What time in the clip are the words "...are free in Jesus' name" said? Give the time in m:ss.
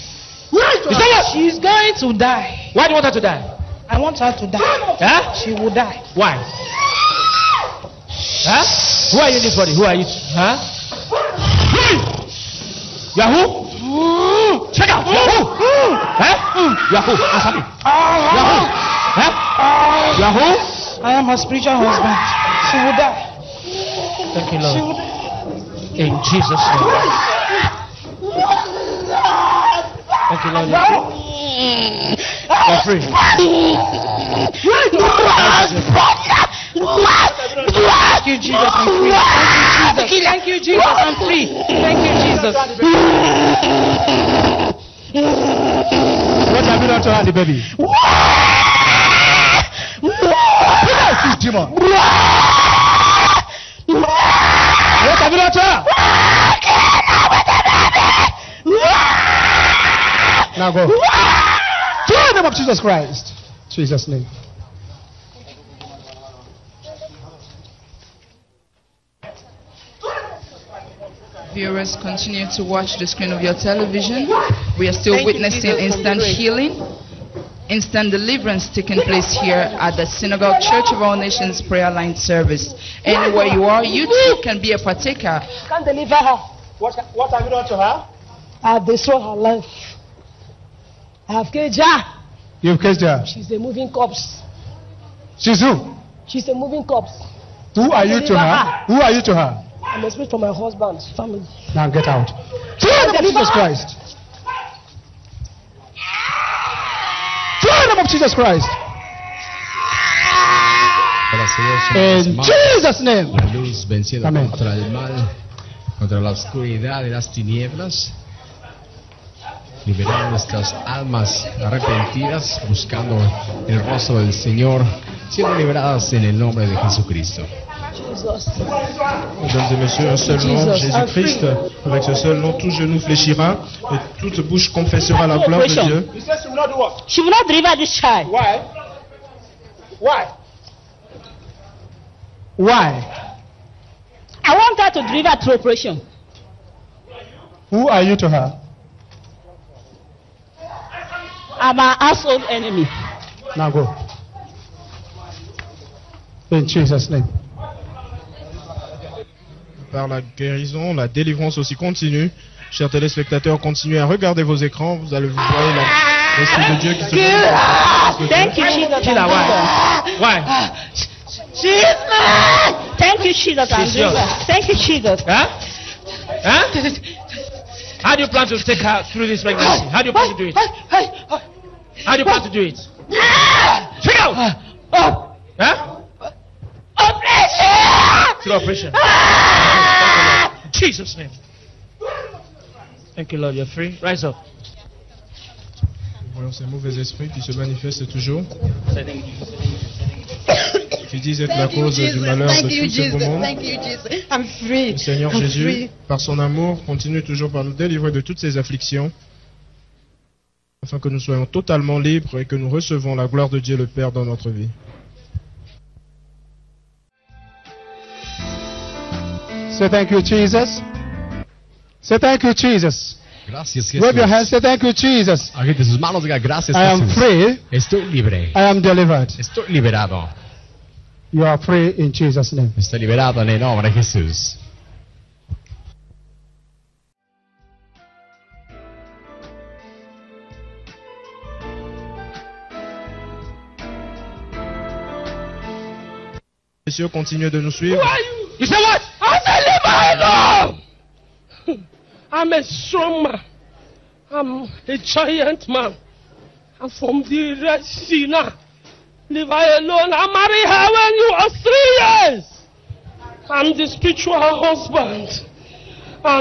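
3:51.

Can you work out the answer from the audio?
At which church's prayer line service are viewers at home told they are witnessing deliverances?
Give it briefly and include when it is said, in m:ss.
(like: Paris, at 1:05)
Synagogue Church of All Nations, at 1:20.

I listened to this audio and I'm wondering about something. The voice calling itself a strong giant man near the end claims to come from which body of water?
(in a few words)
The Red Sea.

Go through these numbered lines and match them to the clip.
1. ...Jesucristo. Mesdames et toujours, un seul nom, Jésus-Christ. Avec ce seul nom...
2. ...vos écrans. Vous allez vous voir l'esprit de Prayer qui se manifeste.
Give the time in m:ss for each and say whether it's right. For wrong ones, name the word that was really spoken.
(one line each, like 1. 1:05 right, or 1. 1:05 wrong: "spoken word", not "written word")
1. 2:06 wrong: "messieurs", not "toujours"
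2. 2:44 wrong: "Dieu", not "Prayer".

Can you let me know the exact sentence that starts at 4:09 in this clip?
I'm Father, I'm a strong man.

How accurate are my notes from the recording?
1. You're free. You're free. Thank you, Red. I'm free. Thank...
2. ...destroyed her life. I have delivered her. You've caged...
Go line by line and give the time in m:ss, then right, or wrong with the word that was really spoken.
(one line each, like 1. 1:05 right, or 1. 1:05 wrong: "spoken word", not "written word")
1. 0:32 wrong: "Jesus", not "Red"
2. 1:28 wrong: "caged", not "delivered".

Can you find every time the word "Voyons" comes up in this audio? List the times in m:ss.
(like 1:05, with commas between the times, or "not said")
3:16.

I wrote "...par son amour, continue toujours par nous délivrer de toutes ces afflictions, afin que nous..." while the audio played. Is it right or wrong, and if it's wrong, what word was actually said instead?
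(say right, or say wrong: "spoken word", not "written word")
right.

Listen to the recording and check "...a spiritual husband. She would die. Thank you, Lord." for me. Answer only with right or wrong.
right.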